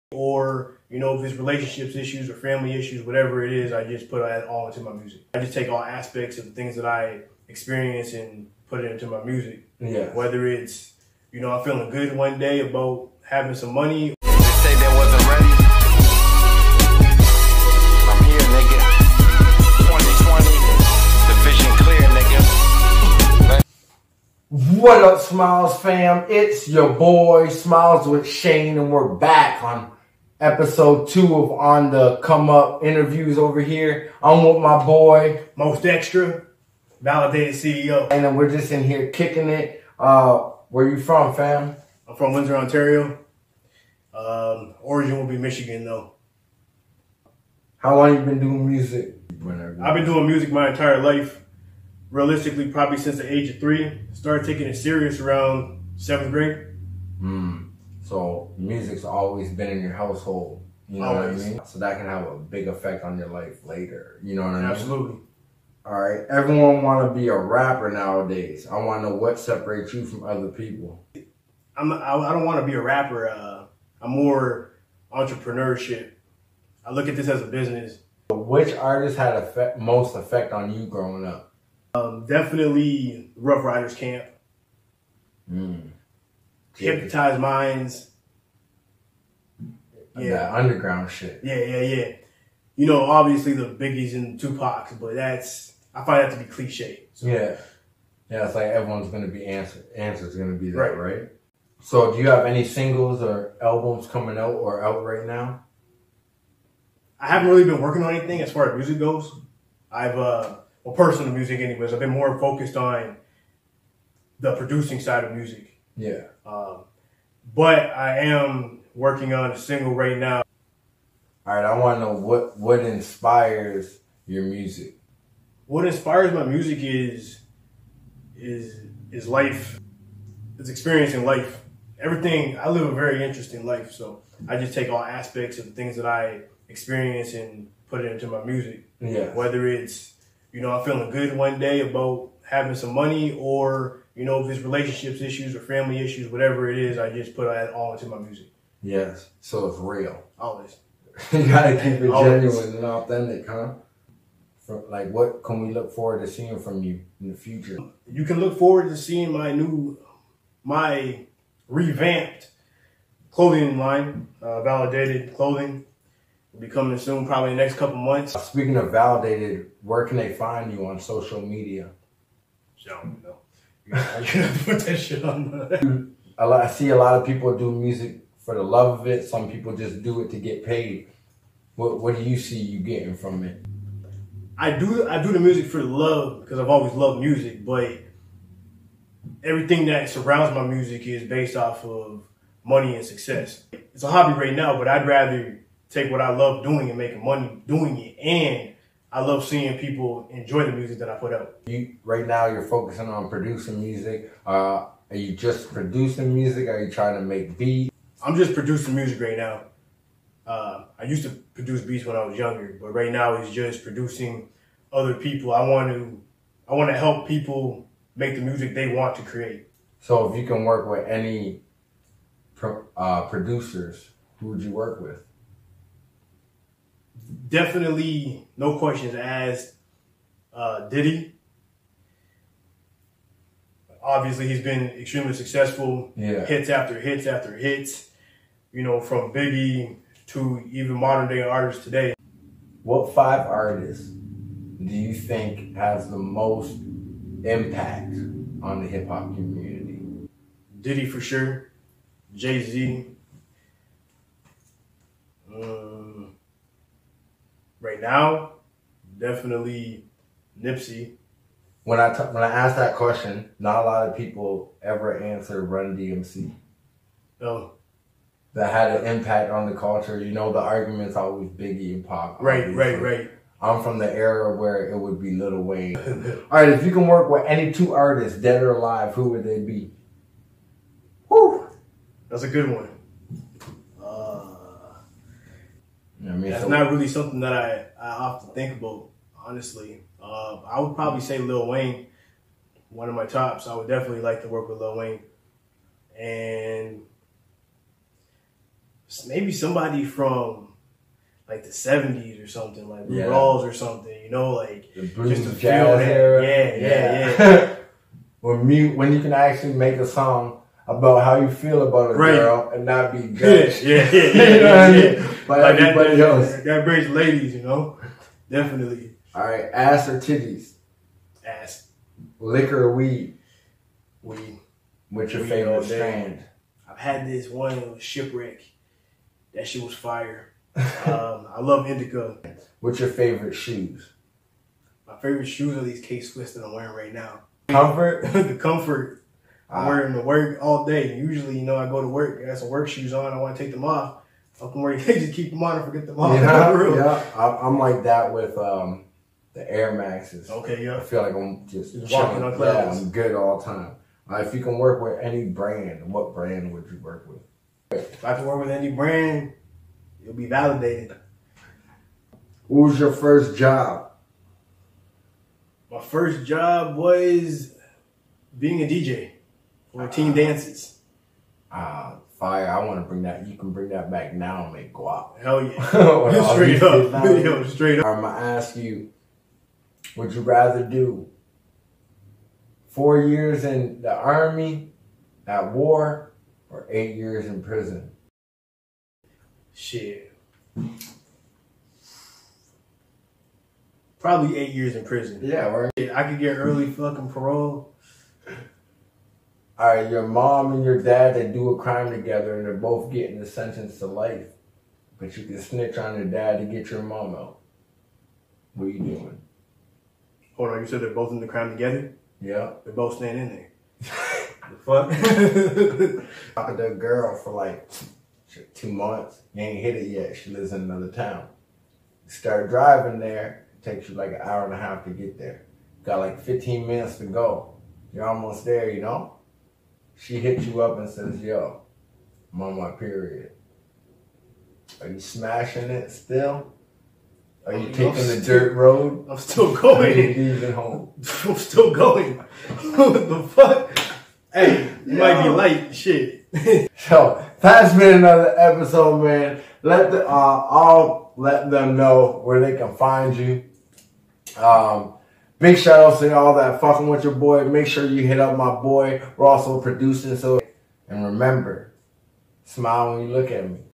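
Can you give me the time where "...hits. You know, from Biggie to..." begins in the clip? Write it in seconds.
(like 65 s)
237 s.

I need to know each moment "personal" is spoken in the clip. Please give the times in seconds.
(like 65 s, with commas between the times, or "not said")
110 s.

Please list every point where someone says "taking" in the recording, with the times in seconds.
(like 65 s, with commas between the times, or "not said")
54 s, 437 s.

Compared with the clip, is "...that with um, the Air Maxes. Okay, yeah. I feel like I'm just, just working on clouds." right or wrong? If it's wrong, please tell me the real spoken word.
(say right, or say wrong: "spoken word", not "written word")
wrong: "walking", not "working".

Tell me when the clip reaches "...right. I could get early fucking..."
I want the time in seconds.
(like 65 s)
395 s.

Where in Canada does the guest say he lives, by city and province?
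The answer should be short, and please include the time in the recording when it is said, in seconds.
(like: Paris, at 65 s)
Windsor, Ontario, at 42 s.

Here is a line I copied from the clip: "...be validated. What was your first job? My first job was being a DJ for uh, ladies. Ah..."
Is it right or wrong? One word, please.
wrong.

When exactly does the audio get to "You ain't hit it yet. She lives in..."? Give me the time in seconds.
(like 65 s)
419 s.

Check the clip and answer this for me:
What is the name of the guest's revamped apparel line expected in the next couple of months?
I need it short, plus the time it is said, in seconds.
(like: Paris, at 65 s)
Validated Clothing, at 164 s.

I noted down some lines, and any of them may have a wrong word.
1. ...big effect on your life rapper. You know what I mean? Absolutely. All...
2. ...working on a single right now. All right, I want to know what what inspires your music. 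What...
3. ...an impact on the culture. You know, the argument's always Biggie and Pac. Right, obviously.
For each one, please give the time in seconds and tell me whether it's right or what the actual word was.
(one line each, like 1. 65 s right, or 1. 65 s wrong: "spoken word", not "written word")
1. 62 s wrong: "later", not "rapper"
2. 118 s right
3. 269 s right.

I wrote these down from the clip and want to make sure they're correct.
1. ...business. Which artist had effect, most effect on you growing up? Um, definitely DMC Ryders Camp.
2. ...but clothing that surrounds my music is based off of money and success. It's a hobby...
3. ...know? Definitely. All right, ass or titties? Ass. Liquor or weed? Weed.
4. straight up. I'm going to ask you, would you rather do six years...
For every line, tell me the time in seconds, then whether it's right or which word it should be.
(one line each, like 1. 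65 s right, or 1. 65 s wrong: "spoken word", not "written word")
1. 77 s wrong: "Ruff", not "DMC"
2. 187 s wrong: "everything", not "clothing"
3. 317 s right
4. 377 s wrong: "four", not "six".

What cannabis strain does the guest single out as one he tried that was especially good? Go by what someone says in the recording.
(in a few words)
Shipwreck.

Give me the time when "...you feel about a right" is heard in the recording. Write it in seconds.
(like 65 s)
311 s.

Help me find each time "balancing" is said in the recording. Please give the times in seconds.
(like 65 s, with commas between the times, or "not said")
not said.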